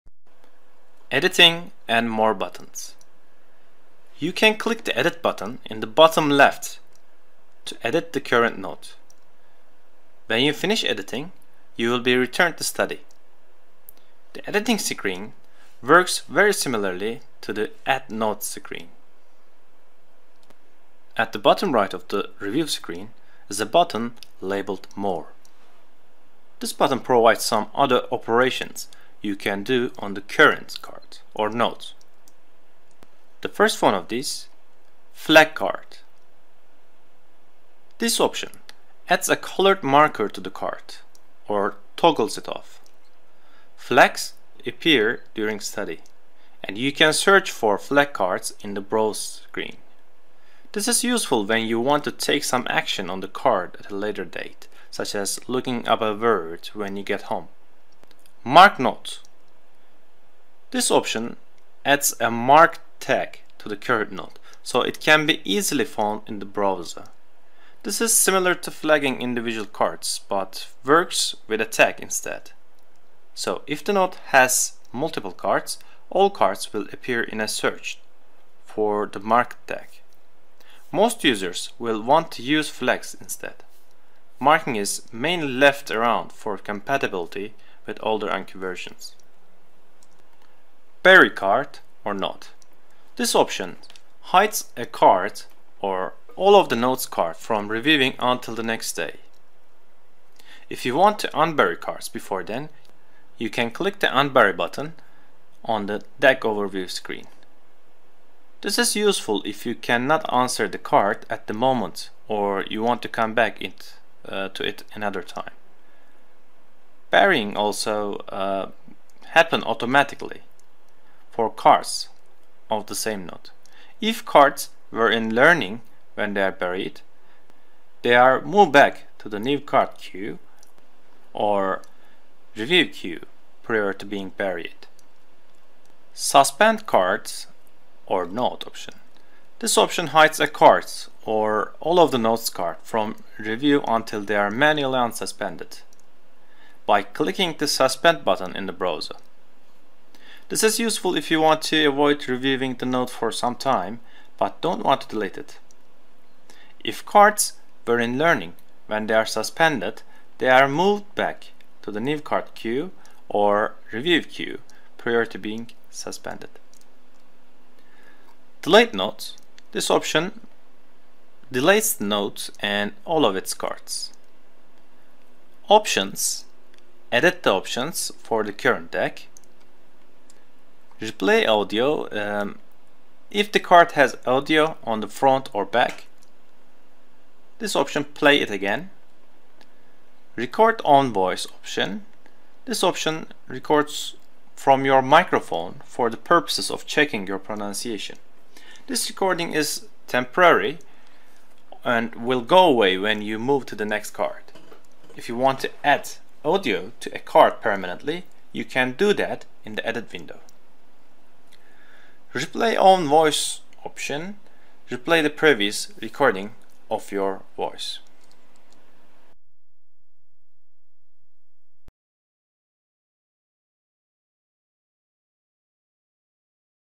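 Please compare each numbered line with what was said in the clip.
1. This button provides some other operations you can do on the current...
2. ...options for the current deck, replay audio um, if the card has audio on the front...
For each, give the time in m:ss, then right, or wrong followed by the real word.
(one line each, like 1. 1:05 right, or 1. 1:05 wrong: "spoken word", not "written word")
1. 0:26 right
2. 2:57 right.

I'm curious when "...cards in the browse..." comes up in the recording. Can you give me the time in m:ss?
0:48.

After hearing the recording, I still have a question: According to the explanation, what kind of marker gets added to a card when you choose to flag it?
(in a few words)
colored marker.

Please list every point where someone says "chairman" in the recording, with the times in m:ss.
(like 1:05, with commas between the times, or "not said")
not said.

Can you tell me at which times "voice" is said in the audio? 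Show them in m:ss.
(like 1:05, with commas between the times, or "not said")
3:11, 3:33, 3:37.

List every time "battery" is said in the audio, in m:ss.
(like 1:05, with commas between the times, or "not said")
not said.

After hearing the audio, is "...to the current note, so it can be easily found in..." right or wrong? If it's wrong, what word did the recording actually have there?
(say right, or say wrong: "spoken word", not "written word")
right.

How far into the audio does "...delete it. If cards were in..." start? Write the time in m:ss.
2:35.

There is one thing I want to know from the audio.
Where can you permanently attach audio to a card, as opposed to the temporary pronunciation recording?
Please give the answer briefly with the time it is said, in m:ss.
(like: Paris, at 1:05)
edit window, at 3:29.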